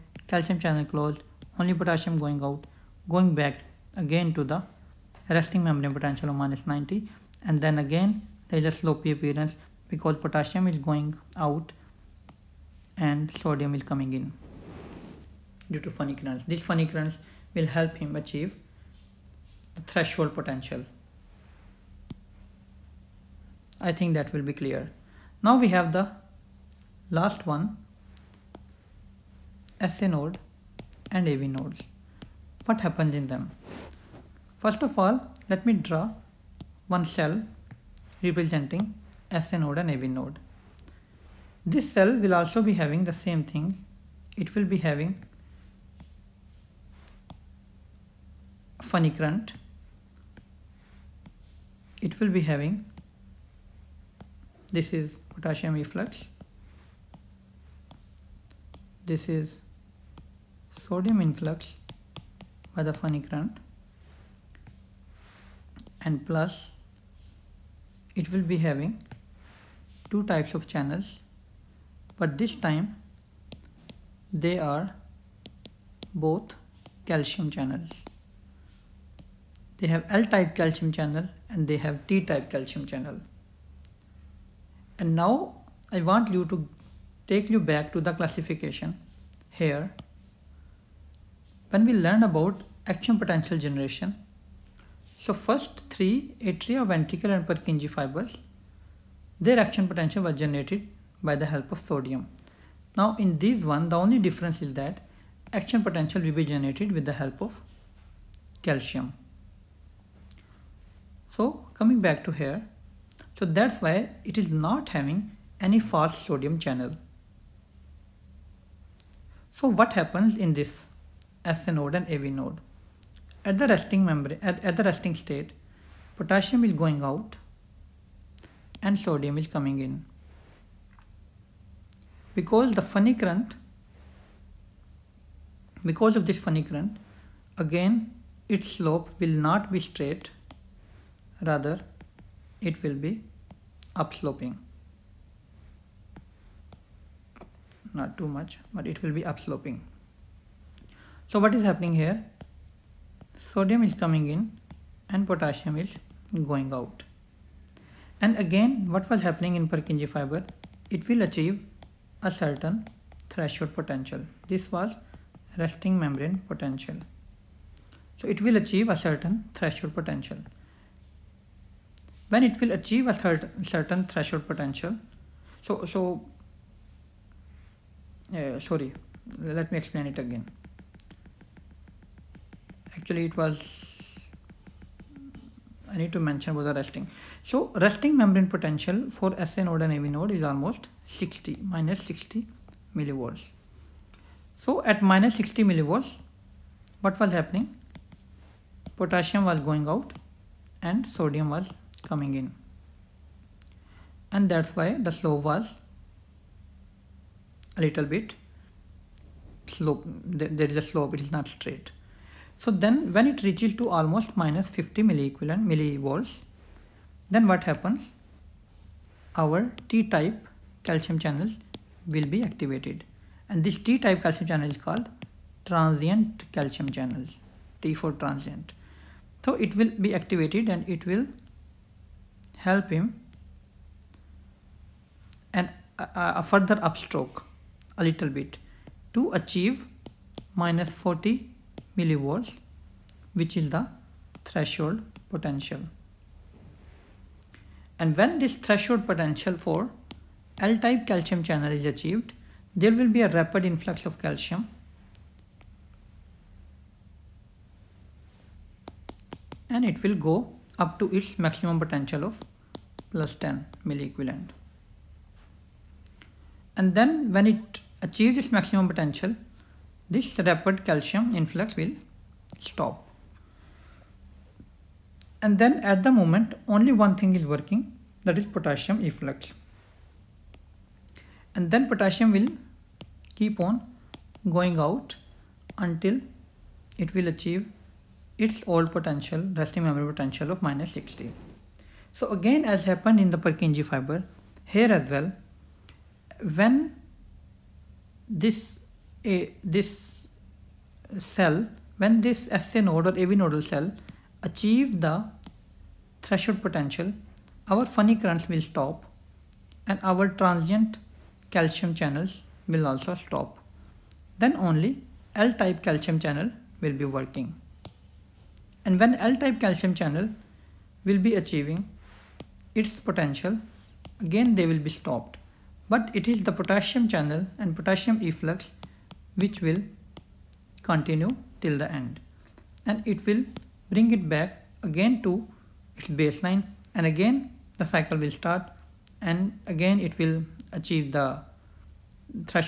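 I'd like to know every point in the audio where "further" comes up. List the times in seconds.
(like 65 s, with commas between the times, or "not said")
236 s.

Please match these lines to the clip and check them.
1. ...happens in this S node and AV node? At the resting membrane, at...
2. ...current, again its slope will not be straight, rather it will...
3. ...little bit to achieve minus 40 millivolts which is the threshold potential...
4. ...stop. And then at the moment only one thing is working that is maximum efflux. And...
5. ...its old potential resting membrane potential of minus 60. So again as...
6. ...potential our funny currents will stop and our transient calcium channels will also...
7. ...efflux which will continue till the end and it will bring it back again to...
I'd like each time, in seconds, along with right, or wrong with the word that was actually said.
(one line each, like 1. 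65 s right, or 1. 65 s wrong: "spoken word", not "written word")
1. 119 s right
2. 136 s right
3. 238 s right
4. 272 s wrong: "potassium", not "maximum"
5. 288 s right
6. 306 s right
7. 328 s right.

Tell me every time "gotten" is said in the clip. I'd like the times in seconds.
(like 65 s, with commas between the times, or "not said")
not said.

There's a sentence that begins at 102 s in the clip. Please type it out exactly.
Now in this one, the only difference is that action potential will be generated with the help of calcium.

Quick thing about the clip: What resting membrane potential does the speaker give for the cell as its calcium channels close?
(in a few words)
-90.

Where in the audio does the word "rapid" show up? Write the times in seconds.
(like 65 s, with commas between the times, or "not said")
253 s, 270 s.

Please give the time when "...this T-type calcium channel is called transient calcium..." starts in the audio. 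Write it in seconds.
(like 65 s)
223 s.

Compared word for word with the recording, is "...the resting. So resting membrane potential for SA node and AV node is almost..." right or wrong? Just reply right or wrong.
right.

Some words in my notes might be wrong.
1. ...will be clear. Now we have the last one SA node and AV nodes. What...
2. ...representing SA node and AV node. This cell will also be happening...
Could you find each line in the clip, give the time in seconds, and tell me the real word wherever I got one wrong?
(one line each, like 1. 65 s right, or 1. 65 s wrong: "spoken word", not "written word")
1. 24 s right
2. 38 s wrong: "having", not "happening".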